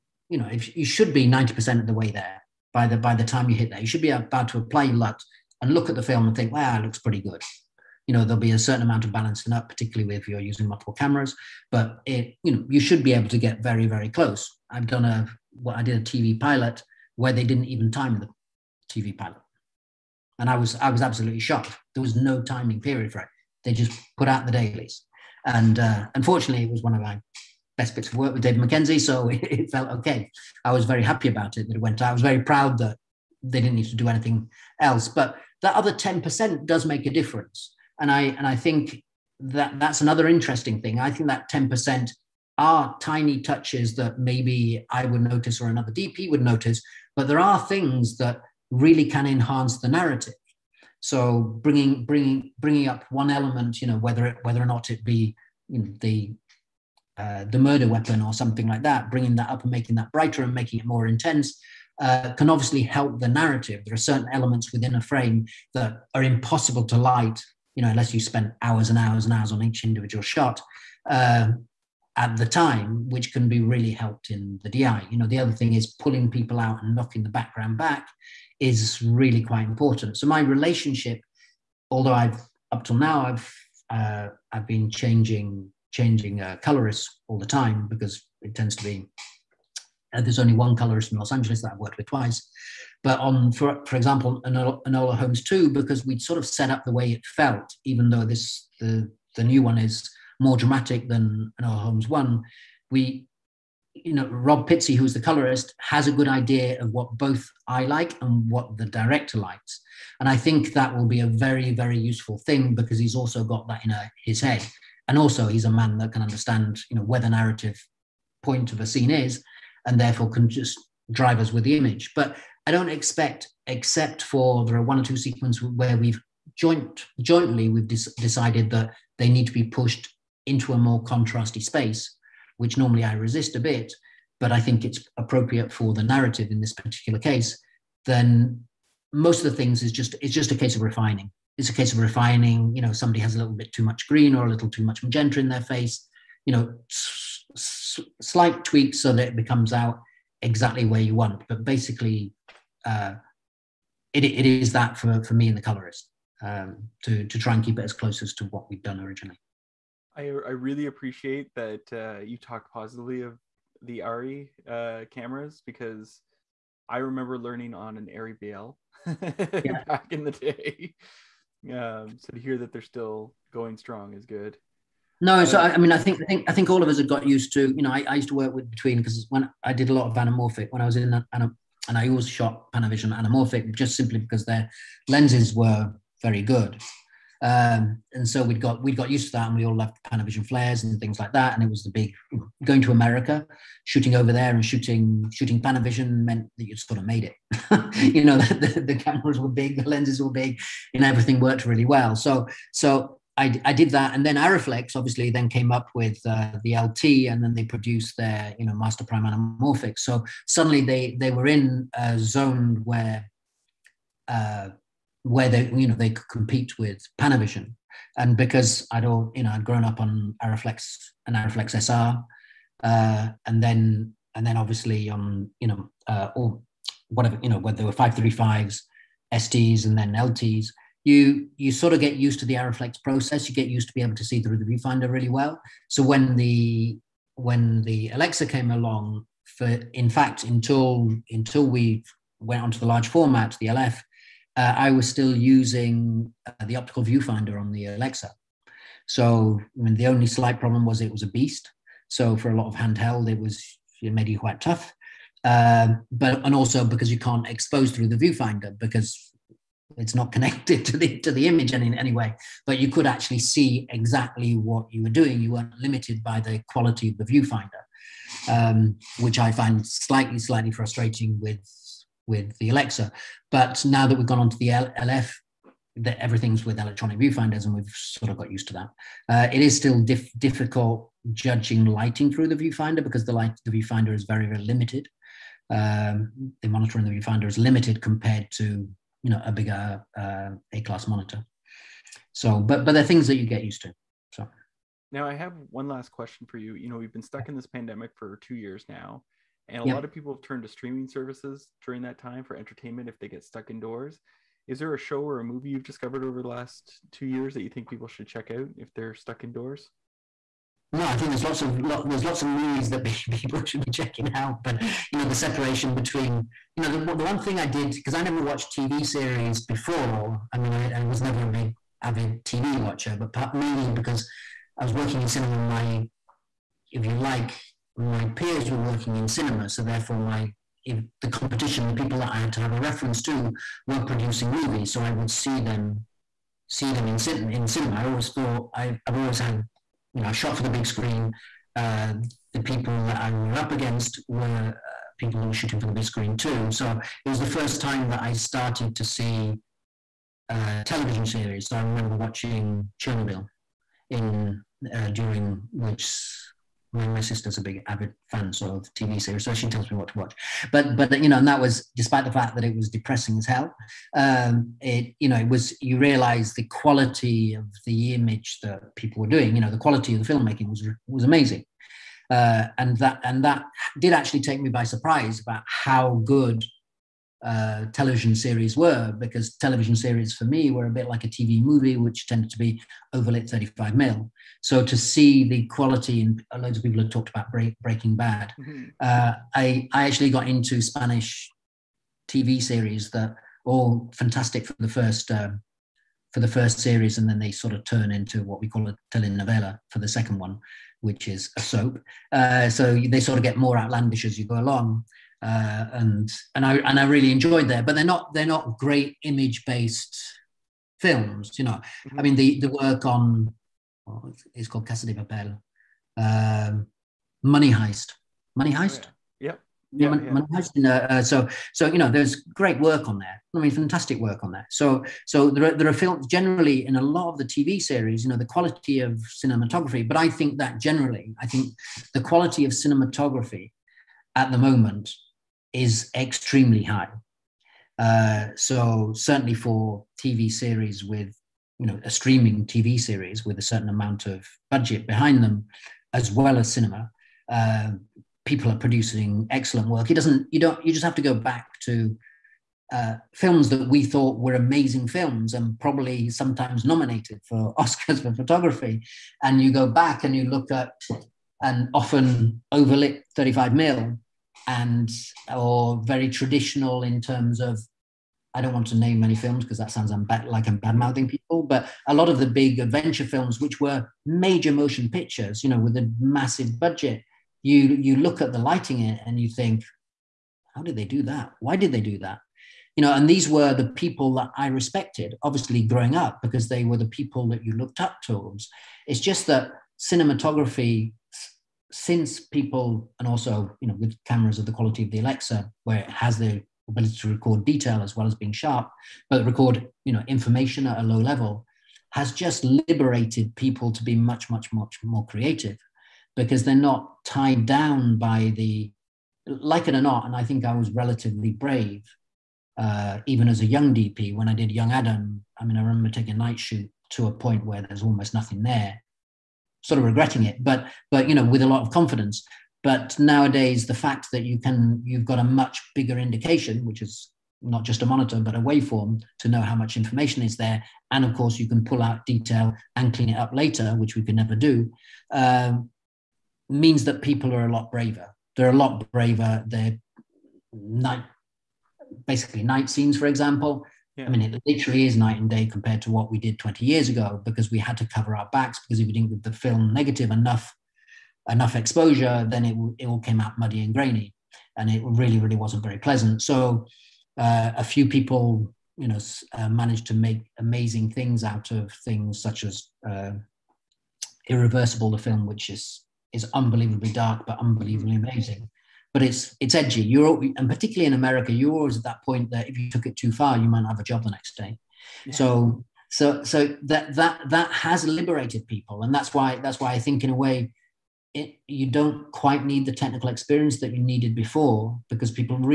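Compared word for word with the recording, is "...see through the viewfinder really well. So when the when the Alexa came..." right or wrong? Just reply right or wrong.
right.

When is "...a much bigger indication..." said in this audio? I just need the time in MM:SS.
08:45.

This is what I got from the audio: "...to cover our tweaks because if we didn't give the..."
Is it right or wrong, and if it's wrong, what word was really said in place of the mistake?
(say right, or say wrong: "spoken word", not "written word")
wrong: "backs", not "tweaks".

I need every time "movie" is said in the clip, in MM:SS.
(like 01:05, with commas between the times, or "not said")
05:05, 05:12, 05:34, 06:21.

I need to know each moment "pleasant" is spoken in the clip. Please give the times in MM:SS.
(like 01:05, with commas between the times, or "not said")
09:15.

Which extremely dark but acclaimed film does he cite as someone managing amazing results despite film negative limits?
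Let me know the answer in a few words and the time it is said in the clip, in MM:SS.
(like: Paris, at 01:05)
Irreversible, at 09:24.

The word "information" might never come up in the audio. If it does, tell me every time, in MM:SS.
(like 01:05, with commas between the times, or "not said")
08:20, 08:49.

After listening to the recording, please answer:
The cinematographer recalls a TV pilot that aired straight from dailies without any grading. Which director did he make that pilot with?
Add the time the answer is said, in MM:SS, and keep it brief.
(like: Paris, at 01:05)
David Mackenzie, at 00:28.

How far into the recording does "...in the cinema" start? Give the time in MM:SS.
05:37.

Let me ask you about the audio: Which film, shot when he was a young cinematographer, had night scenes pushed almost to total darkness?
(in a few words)
Young Adam.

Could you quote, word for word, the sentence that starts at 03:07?
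Um, and so we'd got we'd got used to that, and we all loved Panavision flares and things like that.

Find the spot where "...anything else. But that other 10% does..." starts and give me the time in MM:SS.
00:34.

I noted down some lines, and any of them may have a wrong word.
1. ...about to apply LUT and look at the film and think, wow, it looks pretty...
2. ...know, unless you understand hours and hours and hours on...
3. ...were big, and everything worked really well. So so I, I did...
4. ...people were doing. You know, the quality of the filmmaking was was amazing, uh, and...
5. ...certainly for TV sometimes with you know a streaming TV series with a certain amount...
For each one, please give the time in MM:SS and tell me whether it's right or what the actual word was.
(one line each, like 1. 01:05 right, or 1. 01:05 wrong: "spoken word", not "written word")
1. 00:04 right
2. 01:07 wrong: "spend", not "understand"
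3. 03:20 right
4. 06:08 right
5. 07:19 wrong: "series", not "sometimes".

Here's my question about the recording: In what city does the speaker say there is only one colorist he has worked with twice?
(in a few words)
Los Angeles.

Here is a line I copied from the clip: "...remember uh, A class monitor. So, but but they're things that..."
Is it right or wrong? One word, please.
wrong.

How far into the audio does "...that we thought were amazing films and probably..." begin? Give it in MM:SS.
07:33.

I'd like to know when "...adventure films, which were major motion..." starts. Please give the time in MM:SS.
07:52.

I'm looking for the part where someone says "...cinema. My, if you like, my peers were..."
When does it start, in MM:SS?
05:25.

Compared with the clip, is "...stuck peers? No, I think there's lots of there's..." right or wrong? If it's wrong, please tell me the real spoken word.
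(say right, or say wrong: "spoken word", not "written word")
wrong: "indoors", not "peers".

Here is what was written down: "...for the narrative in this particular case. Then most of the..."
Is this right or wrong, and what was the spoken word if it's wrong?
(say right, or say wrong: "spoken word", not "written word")
right.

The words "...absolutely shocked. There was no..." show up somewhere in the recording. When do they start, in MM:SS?
00:21.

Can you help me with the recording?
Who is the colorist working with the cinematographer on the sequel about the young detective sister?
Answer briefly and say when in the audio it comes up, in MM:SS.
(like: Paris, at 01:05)
Rob Pizzey, at 01:44.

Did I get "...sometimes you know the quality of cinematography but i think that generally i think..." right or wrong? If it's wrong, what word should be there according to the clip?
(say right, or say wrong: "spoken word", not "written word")
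wrong: "series", not "sometimes".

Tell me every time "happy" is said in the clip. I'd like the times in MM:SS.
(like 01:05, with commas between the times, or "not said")
00:31.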